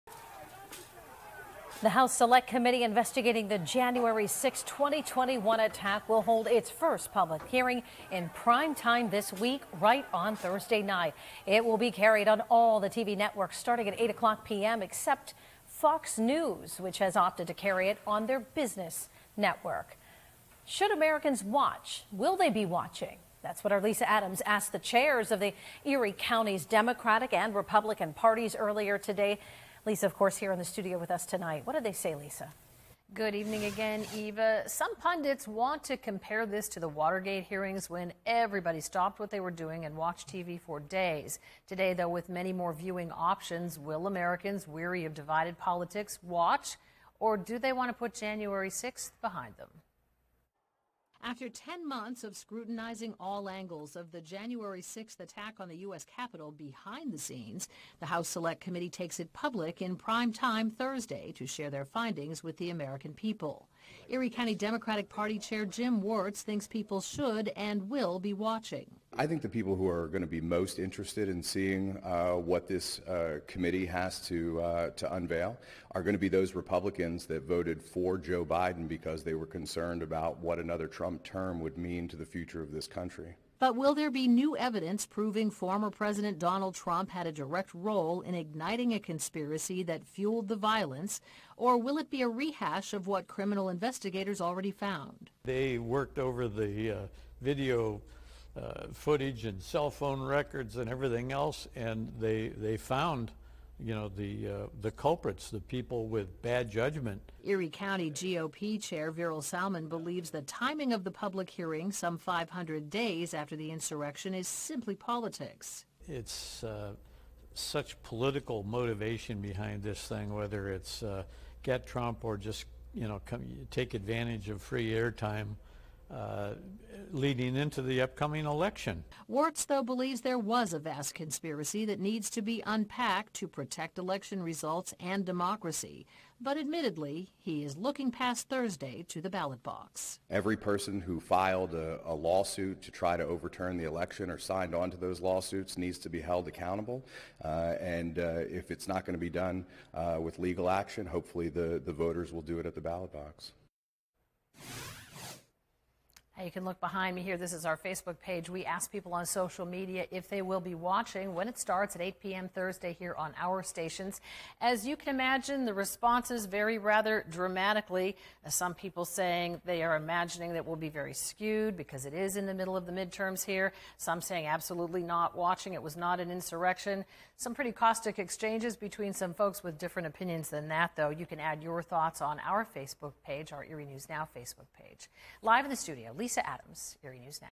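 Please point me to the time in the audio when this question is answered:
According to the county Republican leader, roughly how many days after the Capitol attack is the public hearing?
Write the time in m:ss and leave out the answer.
1:52.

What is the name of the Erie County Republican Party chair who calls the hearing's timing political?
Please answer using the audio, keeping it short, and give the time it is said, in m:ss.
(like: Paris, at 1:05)
Verel Salmon, at 1:49.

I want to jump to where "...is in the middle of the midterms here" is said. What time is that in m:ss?
2:52.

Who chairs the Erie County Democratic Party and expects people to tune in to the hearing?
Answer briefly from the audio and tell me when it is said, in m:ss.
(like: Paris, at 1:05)
Jim Wertz, at 1:05.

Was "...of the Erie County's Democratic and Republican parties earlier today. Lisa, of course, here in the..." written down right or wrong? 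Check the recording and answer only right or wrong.
right.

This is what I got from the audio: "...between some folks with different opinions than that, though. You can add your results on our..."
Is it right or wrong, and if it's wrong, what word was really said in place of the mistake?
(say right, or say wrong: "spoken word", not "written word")
wrong: "thoughts", not "results".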